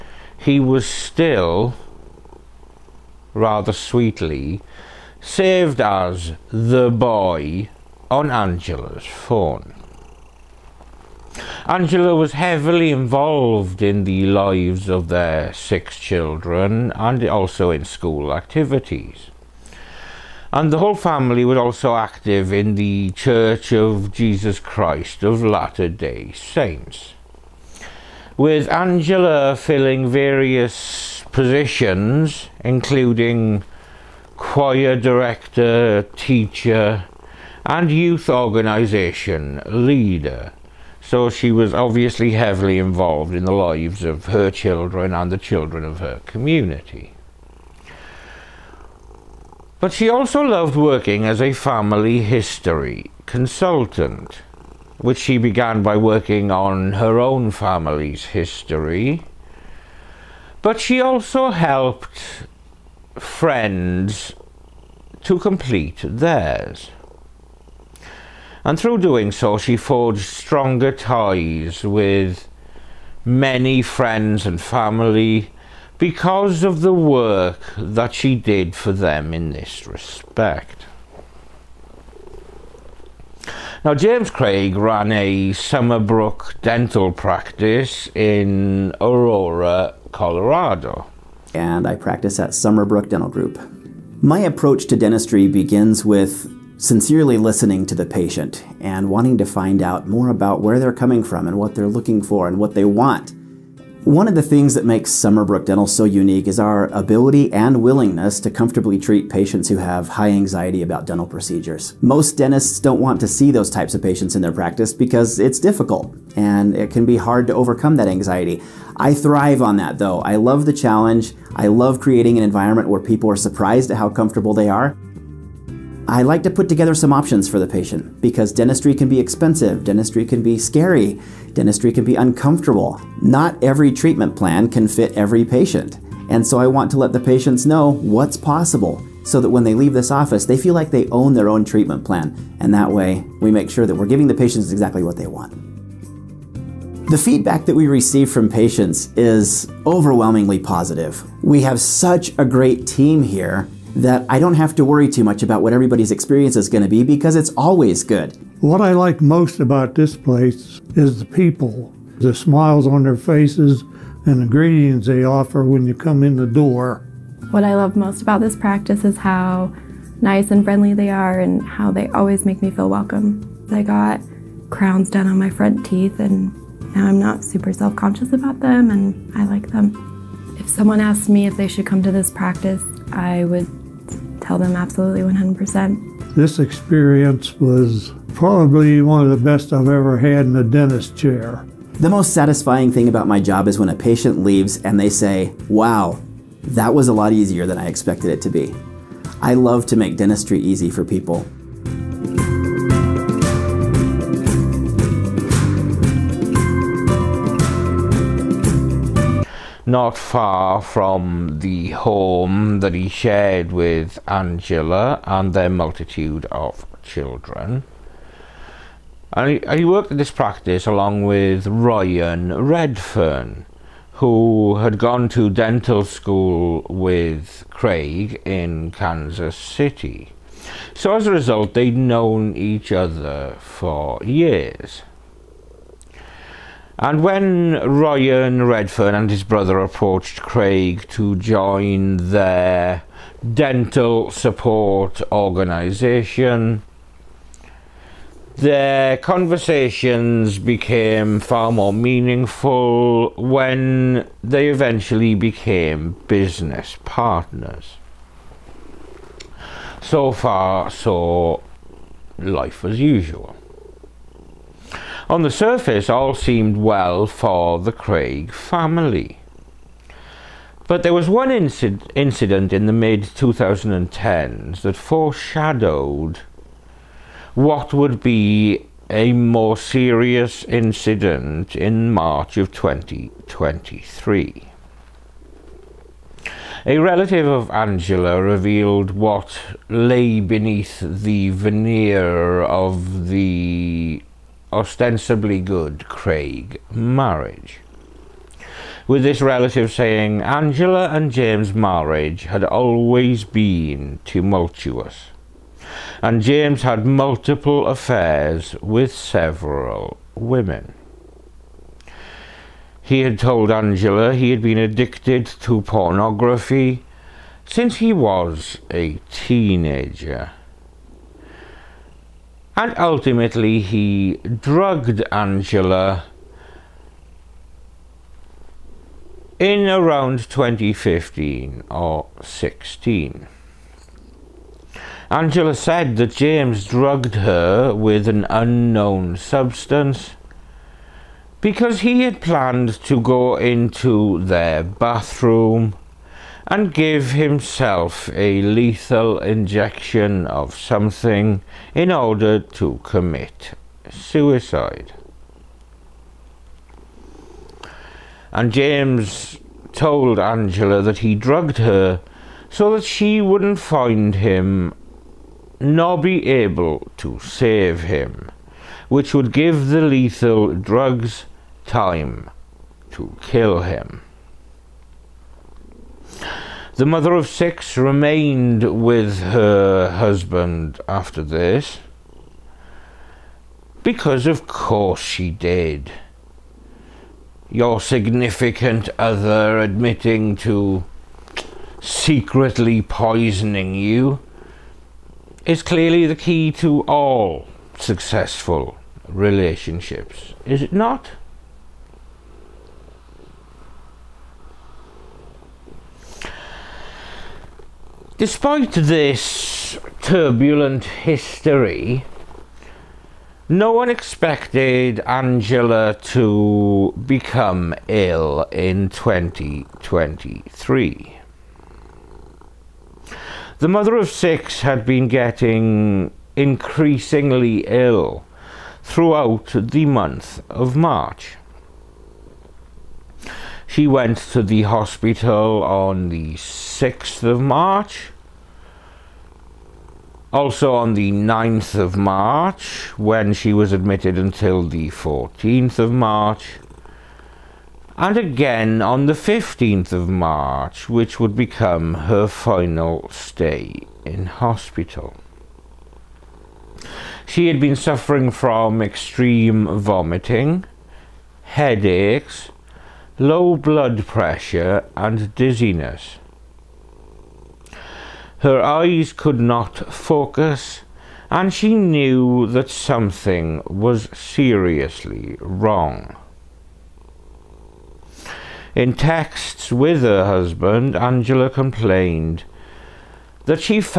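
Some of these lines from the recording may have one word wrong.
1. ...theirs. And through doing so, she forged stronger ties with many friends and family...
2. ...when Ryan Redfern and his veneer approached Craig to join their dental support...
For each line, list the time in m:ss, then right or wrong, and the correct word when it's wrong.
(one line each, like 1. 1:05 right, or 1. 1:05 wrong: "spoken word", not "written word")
1. 1:06 right
2. 3:57 wrong: "brother", not "veneer".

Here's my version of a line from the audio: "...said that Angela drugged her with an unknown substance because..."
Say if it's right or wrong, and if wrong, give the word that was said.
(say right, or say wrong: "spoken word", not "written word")
wrong: "James", not "Angela".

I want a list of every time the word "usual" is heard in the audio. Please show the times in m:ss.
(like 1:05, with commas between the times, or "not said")
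4:22.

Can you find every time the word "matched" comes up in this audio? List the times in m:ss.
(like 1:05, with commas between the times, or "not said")
not said.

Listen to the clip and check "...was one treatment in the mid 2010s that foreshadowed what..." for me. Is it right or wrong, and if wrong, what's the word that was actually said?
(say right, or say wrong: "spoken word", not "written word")
wrong: "incident", not "treatment".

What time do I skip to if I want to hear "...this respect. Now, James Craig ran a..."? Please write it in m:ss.
1:19.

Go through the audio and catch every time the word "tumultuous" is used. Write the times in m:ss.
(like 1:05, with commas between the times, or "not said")
5:04.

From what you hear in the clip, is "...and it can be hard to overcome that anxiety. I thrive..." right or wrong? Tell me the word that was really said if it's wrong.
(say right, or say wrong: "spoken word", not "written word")
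right.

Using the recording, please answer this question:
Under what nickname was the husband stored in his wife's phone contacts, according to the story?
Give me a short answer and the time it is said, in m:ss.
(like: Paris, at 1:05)
the boy, at 0:06.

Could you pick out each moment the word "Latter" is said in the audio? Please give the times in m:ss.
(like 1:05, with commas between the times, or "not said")
0:25.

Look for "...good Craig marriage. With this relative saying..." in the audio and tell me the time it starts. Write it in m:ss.
4:55.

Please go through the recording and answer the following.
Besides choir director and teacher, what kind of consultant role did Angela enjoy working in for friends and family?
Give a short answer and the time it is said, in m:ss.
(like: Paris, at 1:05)
family history consultant, at 0:51.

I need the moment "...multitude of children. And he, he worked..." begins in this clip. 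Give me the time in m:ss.
3:35.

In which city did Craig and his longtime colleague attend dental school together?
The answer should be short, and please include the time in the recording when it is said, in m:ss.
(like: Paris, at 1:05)
Kansas City, at 3:48.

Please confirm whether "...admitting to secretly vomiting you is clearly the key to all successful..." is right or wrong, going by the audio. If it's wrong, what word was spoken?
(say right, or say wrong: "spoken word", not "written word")
wrong: "poisoning", not "vomiting".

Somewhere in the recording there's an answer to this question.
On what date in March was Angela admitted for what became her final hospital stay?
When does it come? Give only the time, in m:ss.
7:29.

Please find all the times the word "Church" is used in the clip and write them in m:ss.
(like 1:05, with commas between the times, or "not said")
0:23.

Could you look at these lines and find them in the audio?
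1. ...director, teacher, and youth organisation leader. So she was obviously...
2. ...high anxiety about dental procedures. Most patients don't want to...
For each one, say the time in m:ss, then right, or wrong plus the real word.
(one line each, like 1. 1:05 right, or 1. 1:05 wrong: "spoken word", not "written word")
1. 0:34 right
2. 1:50 wrong: "dentists", not "patients".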